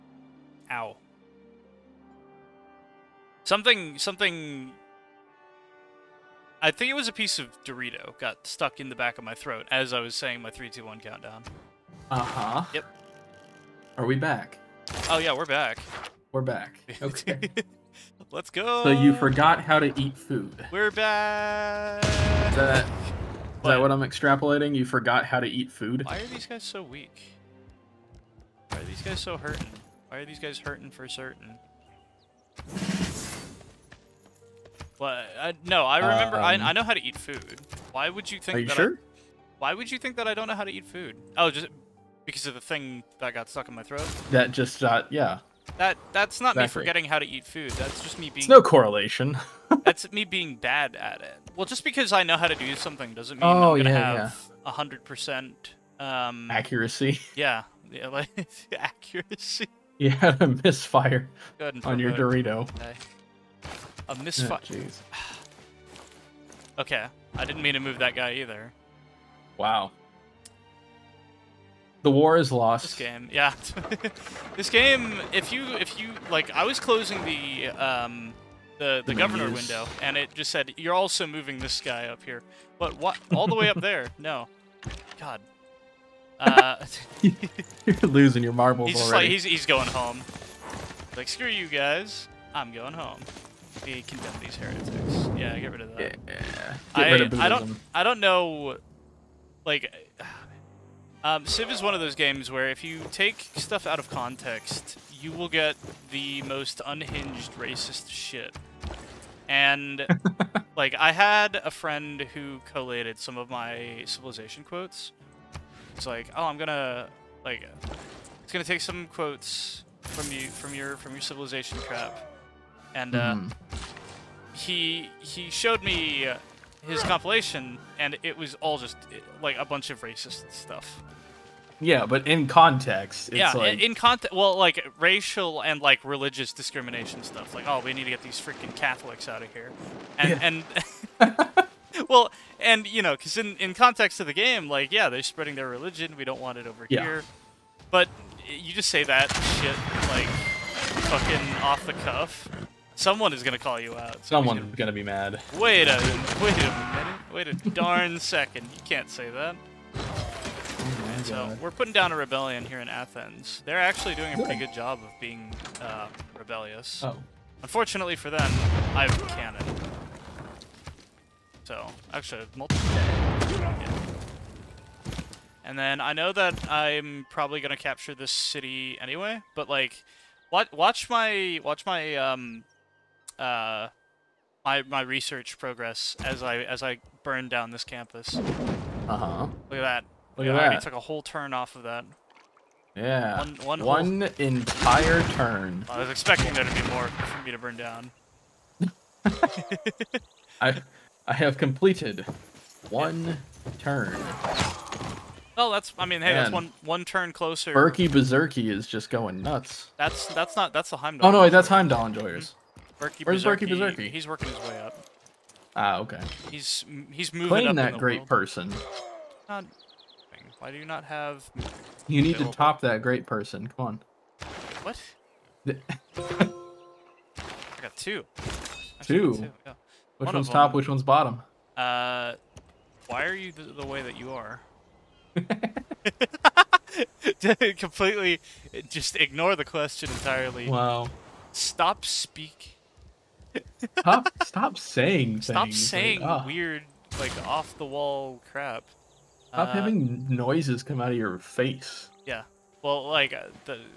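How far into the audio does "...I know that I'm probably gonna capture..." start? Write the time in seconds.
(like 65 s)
175 s.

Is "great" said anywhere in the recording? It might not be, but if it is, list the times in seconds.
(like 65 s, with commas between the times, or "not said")
217 s, 223 s.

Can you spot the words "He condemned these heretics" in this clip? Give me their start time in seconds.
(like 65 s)
93 s.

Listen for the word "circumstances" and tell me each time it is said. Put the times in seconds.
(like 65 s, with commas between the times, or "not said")
not said.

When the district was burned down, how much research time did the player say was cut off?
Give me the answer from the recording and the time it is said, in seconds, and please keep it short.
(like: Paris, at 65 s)
One turn, at 190 s.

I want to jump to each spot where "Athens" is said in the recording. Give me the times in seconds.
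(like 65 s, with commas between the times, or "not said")
162 s.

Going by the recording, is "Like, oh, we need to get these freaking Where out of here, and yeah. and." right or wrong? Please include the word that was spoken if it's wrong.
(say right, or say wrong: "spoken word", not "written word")
wrong: "Catholics", not "Where".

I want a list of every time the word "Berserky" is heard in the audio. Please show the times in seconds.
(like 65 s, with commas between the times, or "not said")
208 s, 213 s.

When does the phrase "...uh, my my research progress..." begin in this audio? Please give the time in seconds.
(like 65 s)
183 s.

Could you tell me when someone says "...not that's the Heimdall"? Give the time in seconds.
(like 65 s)
210 s.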